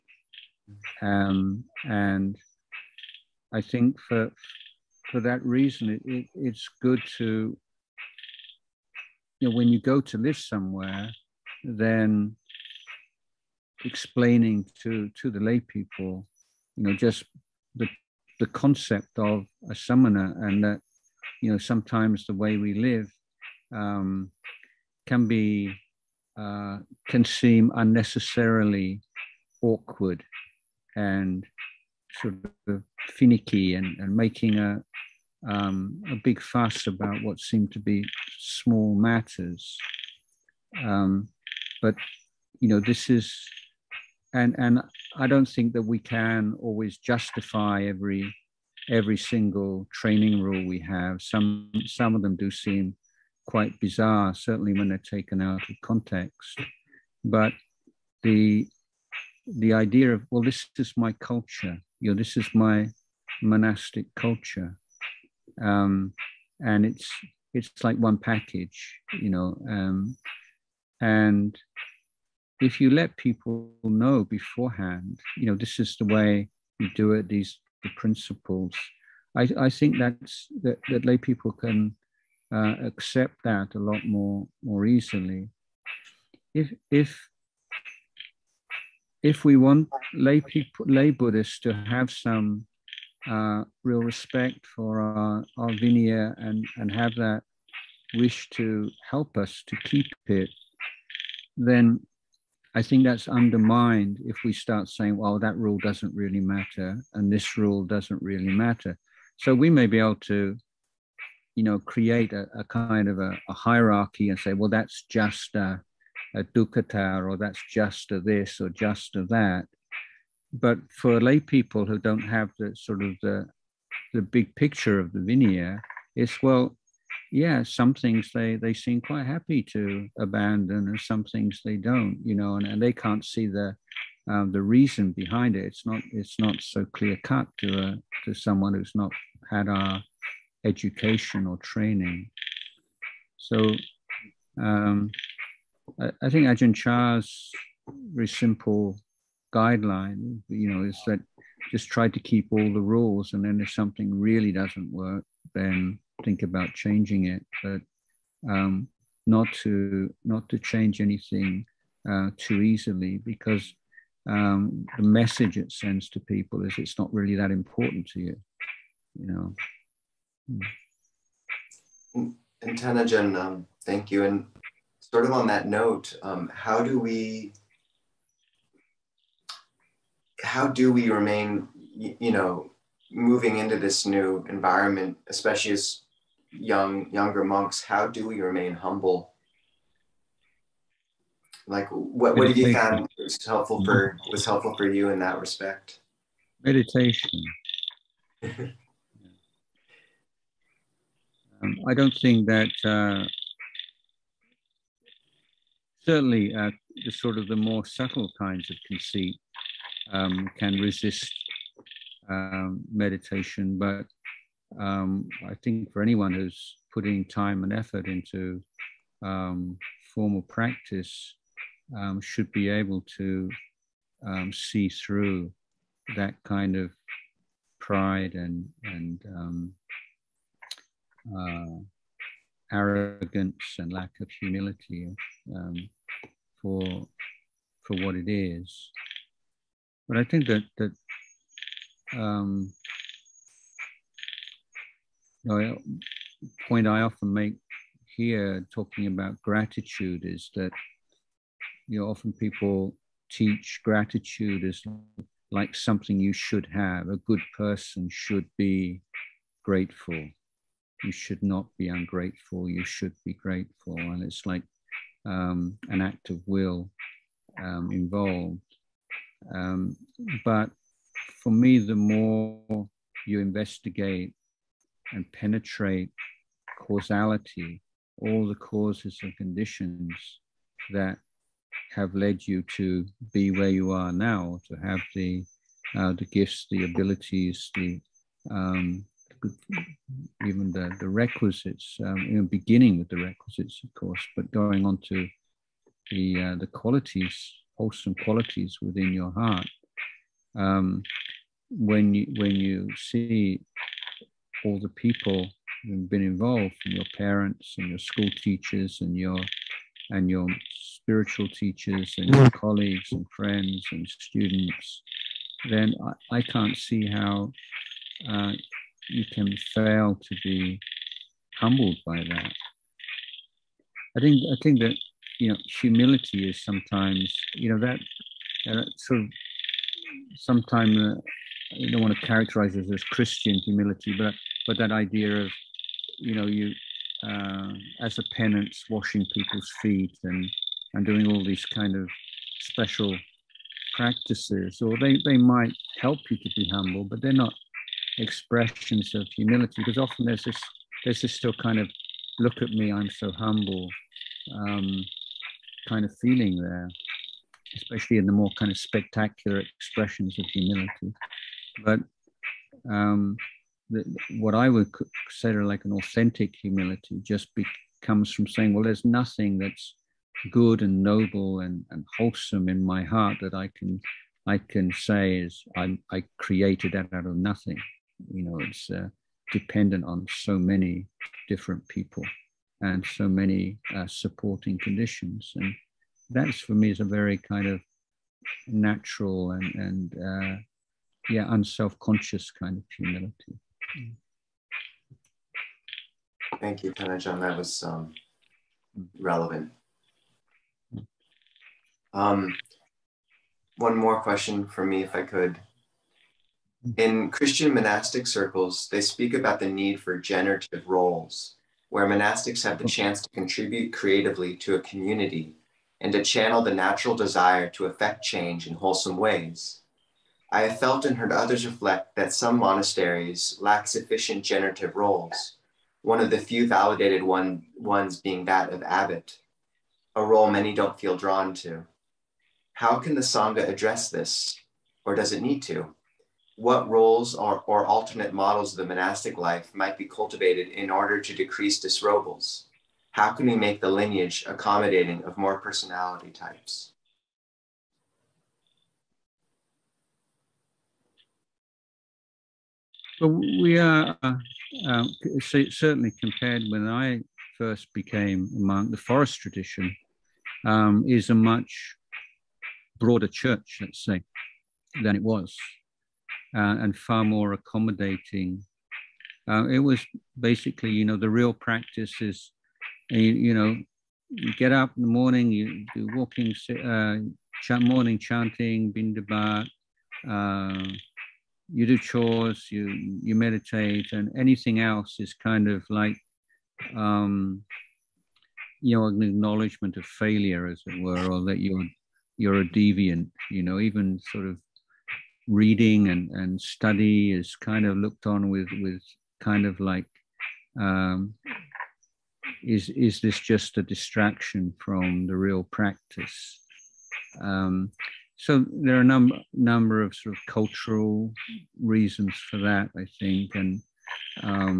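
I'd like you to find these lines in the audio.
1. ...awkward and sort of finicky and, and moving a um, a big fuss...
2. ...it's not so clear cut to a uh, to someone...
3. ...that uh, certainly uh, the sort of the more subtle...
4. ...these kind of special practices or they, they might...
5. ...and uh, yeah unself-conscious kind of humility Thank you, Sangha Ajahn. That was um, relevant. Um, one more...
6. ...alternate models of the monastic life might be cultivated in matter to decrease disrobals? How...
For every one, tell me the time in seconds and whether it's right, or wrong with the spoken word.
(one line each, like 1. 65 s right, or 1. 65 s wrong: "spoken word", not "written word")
1. 29 s wrong: "making", not "moving"
2. 136 s right
3. 202 s right
4. 341 s right
5. 389 s wrong: "Than", not "Sangha"
6. 437 s wrong: "order", not "matter".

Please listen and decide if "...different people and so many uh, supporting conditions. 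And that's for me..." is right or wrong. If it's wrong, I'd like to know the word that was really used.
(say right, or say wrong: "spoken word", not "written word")
right.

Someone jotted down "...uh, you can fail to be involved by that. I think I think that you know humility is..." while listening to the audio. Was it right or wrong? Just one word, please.
wrong.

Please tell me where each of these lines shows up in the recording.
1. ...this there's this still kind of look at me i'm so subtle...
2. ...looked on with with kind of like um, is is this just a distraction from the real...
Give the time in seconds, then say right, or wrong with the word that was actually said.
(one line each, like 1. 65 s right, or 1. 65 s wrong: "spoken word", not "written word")
1. 350 s wrong: "humble", not "subtle"
2. 497 s right.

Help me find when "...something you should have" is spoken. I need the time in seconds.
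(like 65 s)
255 s.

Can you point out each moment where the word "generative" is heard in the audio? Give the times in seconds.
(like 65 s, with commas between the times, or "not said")
410 s, 424 s.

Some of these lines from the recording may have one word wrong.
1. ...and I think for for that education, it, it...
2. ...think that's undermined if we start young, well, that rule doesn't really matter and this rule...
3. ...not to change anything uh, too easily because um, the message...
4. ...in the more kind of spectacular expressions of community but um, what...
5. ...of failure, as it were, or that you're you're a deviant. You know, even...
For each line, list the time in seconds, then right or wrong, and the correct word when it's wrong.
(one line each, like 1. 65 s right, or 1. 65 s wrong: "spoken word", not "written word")
1. 1 s wrong: "reason", not "education"
2. 102 s wrong: "saying", not "young"
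3. 160 s right
4. 358 s wrong: "humility", not "community"
5. 489 s right.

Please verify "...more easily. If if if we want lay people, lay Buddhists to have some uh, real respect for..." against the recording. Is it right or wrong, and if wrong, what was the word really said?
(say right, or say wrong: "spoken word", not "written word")
right.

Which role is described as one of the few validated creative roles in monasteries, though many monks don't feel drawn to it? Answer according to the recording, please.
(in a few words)
Abbot.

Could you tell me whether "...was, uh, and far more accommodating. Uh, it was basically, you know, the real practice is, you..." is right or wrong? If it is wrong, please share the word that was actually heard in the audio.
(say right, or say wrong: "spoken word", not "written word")
right.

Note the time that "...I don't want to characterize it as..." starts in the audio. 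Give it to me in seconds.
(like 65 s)
331 s.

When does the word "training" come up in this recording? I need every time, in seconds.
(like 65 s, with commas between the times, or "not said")
49 s, 141 s.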